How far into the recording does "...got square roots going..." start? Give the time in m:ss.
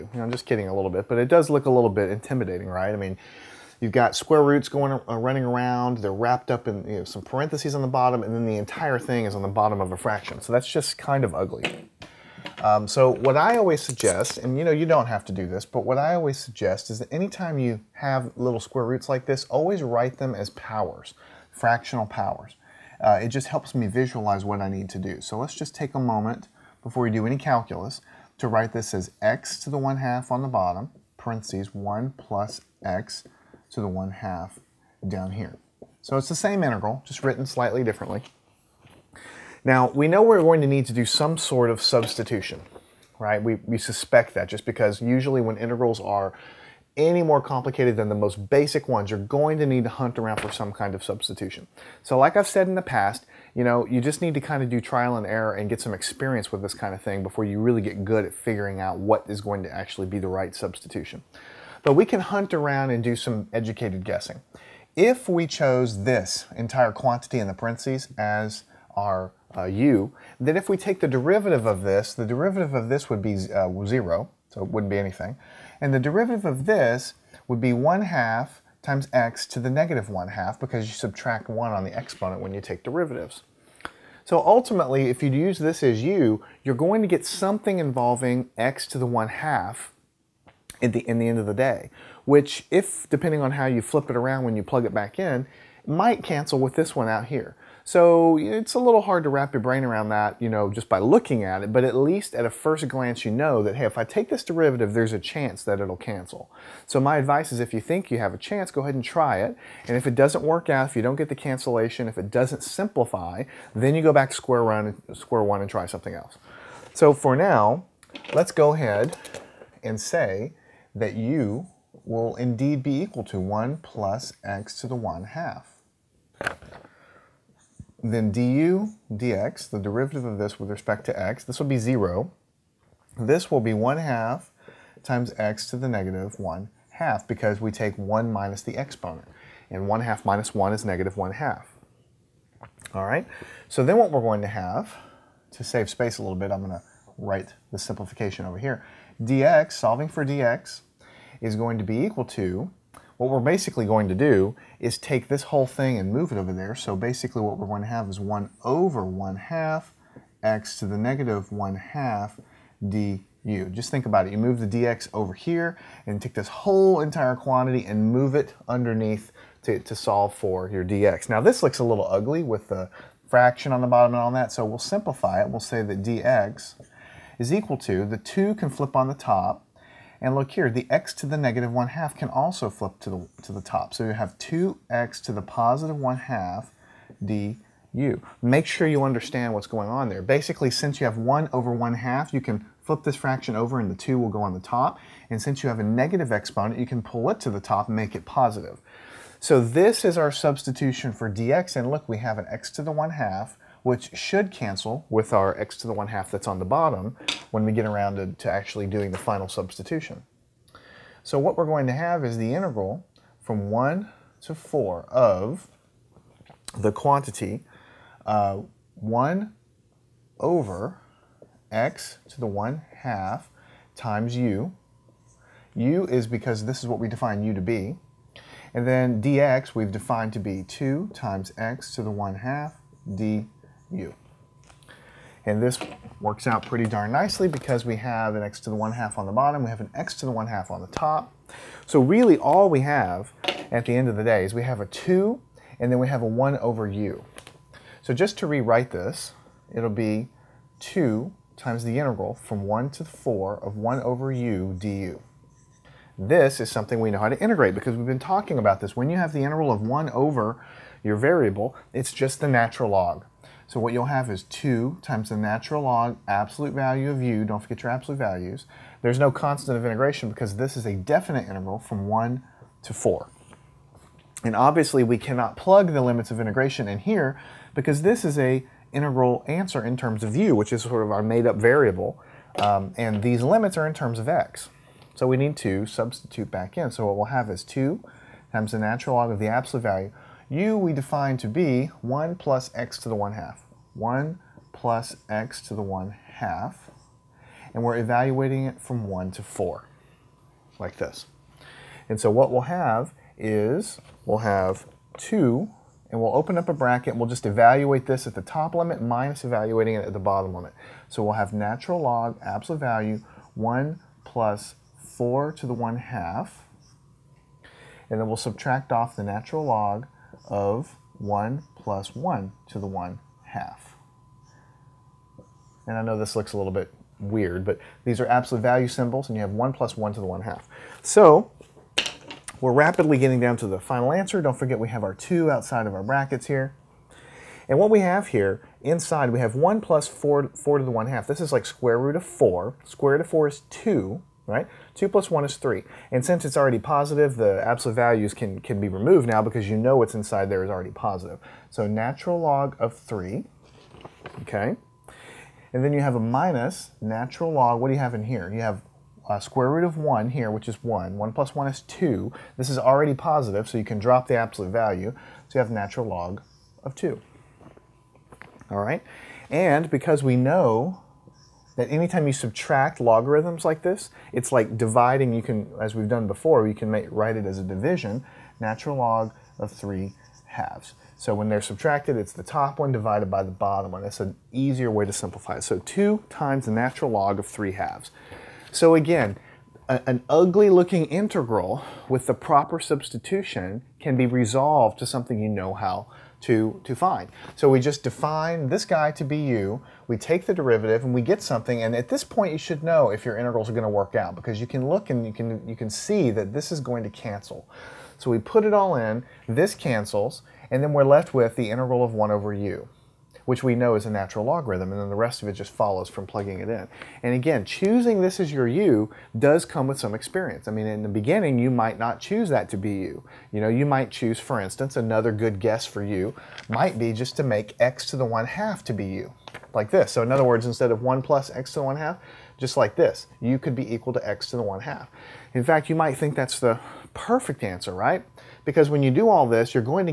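0:03.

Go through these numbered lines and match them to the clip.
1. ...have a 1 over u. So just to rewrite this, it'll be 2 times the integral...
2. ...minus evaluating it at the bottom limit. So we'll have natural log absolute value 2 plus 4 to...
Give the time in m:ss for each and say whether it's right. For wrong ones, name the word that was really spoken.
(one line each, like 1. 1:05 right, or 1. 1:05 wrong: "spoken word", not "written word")
1. 4:06 right
2. 5:09 wrong: "1", not "2".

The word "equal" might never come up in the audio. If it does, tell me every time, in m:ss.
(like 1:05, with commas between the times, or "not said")
2:03, 2:31, 2:57, 7:13.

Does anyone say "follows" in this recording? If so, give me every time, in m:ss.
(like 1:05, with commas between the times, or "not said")
6:55.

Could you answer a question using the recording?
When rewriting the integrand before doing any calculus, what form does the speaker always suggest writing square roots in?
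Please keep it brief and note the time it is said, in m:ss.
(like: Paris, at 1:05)
fractional powers, at 0:21.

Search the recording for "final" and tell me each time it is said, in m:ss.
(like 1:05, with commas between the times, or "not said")
3:29, 5:33.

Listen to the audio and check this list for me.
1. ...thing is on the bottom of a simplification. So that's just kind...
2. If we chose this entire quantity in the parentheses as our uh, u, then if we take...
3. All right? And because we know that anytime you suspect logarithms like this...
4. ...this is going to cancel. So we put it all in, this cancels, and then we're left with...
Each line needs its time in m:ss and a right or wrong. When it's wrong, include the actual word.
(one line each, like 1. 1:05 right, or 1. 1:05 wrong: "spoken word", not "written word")
1. 0:08 wrong: "fraction", not "simplification"
2. 1:04 right
3. 6:08 wrong: "subtract", not "suspect"
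4. 6:46 right.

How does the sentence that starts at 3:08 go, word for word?
Make sure you understand what's going on there.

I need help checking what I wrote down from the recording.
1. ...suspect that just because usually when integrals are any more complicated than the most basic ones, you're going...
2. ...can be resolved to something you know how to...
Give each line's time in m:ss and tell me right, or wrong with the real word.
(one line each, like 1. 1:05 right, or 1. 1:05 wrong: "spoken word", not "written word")
1. 0:43 right
2. 6:33 right.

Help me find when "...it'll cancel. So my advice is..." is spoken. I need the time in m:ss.
1:45.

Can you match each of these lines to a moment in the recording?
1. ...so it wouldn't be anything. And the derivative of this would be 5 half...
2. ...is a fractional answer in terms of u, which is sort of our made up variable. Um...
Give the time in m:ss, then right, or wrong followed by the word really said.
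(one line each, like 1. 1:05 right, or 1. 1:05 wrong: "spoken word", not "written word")
1. 1:14 wrong: "1", not "5"
2. 4:38 wrong: "integral", not "fractional".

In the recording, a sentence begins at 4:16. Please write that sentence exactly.
This is something we know how to integrate because we've been talking about this.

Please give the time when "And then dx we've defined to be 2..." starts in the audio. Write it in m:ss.
3:48.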